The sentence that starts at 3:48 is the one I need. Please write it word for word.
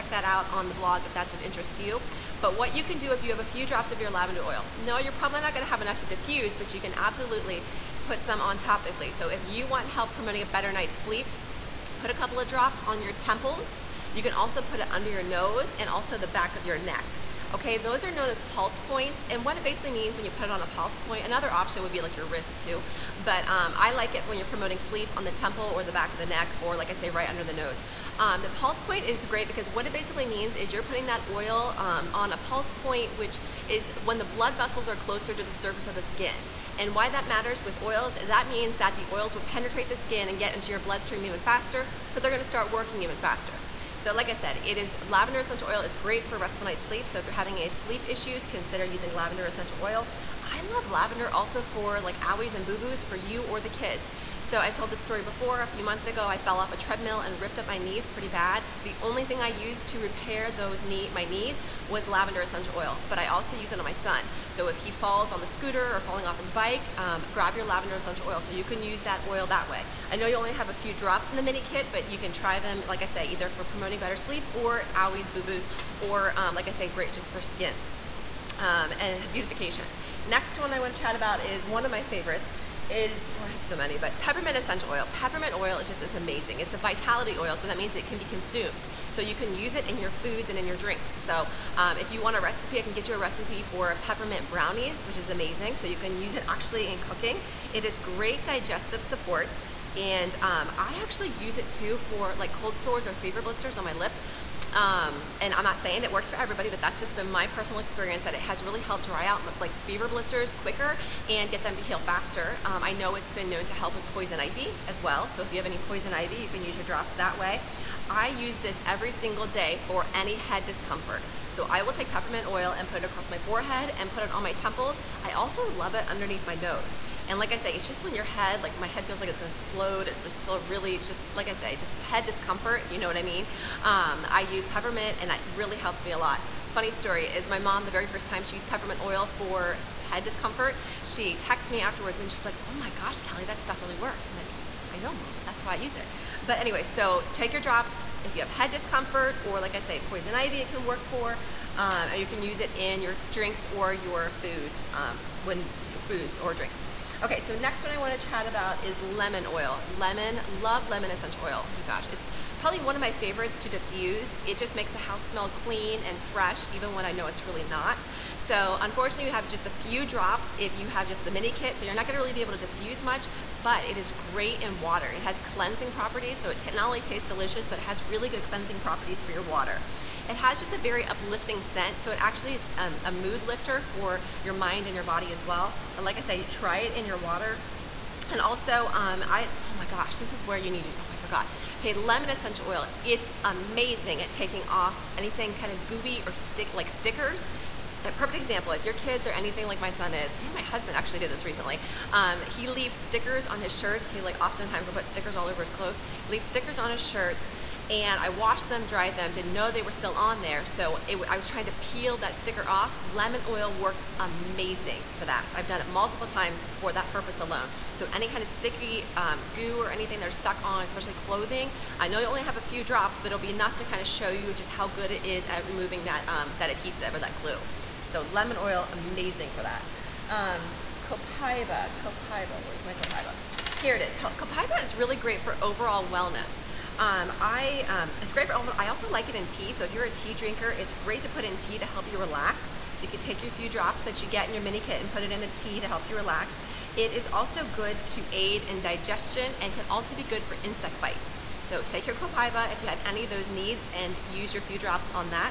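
So lemon oil, amazing for that.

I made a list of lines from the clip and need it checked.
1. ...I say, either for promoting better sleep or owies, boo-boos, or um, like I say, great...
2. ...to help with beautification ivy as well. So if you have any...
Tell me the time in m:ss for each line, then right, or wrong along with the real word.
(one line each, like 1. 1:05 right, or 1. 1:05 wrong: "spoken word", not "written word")
1. 1:13 right
2. 1:53 wrong: "poison", not "beautification".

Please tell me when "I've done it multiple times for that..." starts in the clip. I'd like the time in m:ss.
3:35.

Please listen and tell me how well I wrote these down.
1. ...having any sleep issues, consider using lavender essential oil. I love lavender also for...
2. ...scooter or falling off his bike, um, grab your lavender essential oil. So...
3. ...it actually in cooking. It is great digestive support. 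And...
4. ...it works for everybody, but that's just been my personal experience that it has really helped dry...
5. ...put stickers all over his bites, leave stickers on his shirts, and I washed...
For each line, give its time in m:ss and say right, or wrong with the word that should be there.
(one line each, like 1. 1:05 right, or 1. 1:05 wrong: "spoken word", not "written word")
1. 0:47 right
2. 1:05 right
3. 1:36 right
4. 1:46 right
5. 3:24 wrong: "clothes", not "bites".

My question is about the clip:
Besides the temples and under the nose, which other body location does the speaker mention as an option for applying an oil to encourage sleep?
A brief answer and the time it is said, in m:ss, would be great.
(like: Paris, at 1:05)
Wrist, at 0:22.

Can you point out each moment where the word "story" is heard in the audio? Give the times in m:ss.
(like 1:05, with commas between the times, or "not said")
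0:54, 2:16.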